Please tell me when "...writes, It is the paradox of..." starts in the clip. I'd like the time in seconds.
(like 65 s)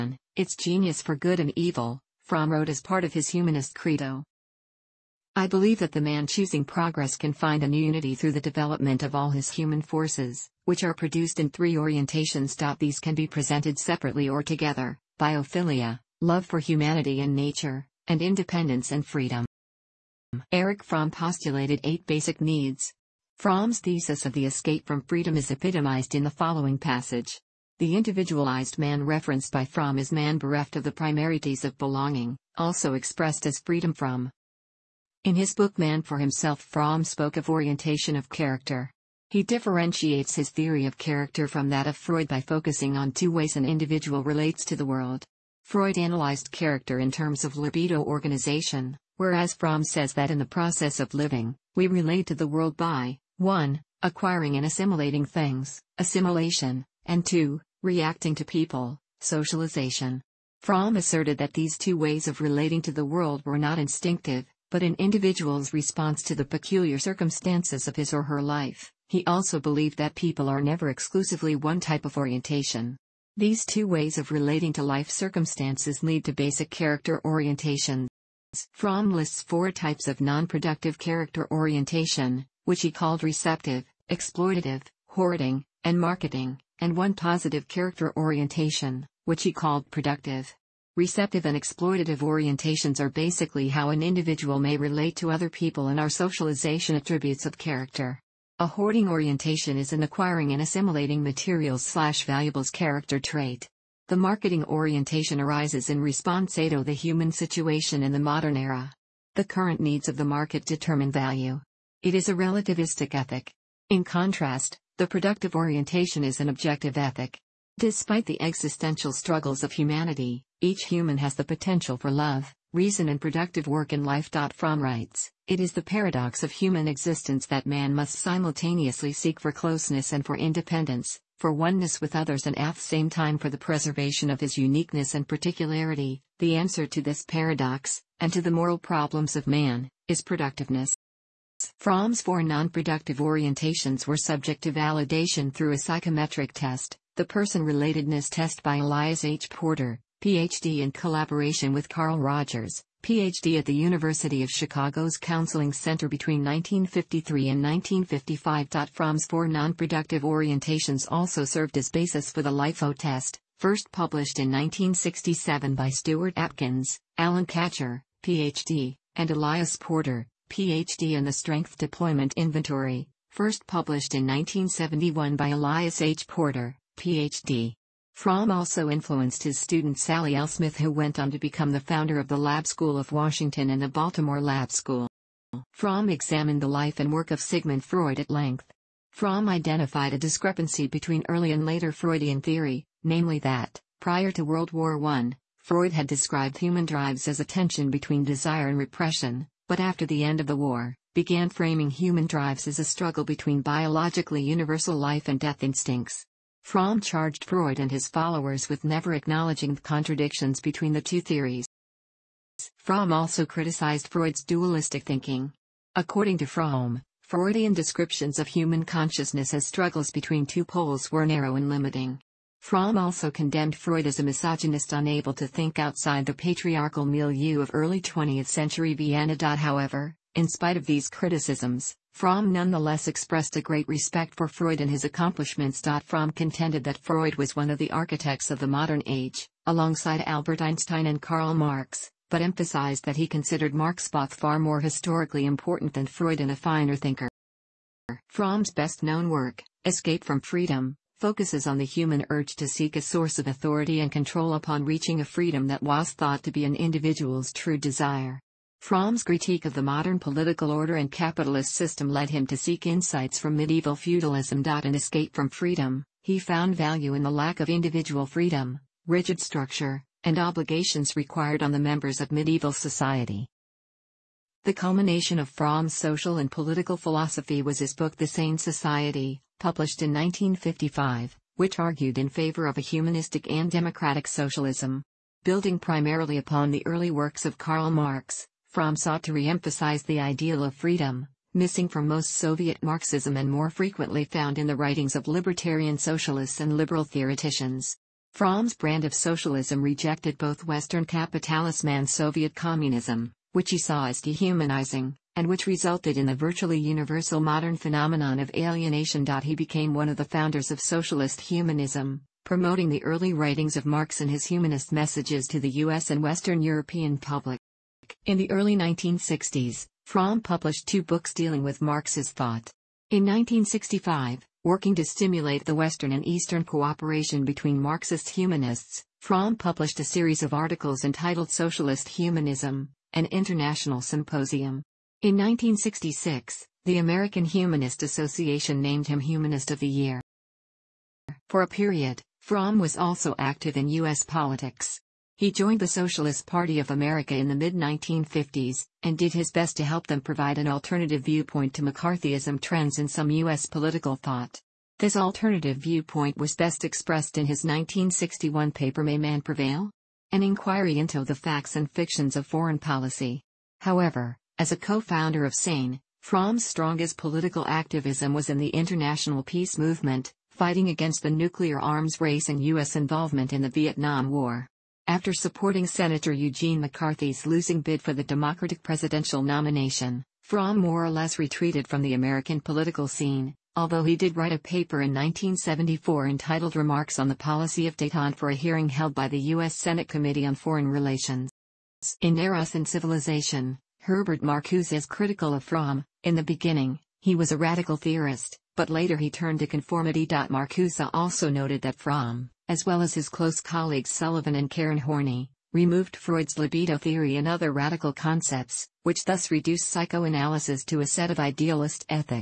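124 s.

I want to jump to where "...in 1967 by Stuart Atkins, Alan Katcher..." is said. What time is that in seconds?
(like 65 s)
164 s.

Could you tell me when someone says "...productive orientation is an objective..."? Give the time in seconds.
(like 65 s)
115 s.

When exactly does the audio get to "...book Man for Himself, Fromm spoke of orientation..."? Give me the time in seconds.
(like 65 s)
35 s.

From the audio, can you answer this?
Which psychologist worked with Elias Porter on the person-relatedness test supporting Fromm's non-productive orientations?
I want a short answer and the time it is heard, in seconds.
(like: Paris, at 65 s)
Carl Rogers, at 151 s.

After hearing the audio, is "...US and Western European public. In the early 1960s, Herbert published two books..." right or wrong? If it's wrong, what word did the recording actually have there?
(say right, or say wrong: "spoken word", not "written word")
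wrong: "Fromm", not "Herbert".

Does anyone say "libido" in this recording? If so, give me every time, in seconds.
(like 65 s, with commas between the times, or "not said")
47 s, 406 s.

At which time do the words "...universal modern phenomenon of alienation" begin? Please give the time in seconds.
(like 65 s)
306 s.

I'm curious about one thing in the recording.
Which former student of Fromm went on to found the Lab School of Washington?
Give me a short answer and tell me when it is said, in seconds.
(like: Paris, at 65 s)
Sally L. Smith, at 179 s.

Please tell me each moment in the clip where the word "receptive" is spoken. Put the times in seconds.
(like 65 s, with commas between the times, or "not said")
83 s, 90 s.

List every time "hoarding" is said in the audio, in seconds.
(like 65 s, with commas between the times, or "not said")
85 s, 98 s.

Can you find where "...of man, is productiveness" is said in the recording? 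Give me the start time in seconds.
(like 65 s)
139 s.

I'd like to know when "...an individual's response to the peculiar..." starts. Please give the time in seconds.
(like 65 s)
64 s.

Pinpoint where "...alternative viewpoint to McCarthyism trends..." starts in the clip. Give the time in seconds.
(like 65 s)
350 s.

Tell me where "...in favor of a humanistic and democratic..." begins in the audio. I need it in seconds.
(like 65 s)
282 s.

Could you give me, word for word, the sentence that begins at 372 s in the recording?
involvement in the Vietnam War after supporting Senator Eugene McCarthy's losing bid for the Democratic presidential nomination.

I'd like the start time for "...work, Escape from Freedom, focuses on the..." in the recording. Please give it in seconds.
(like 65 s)
249 s.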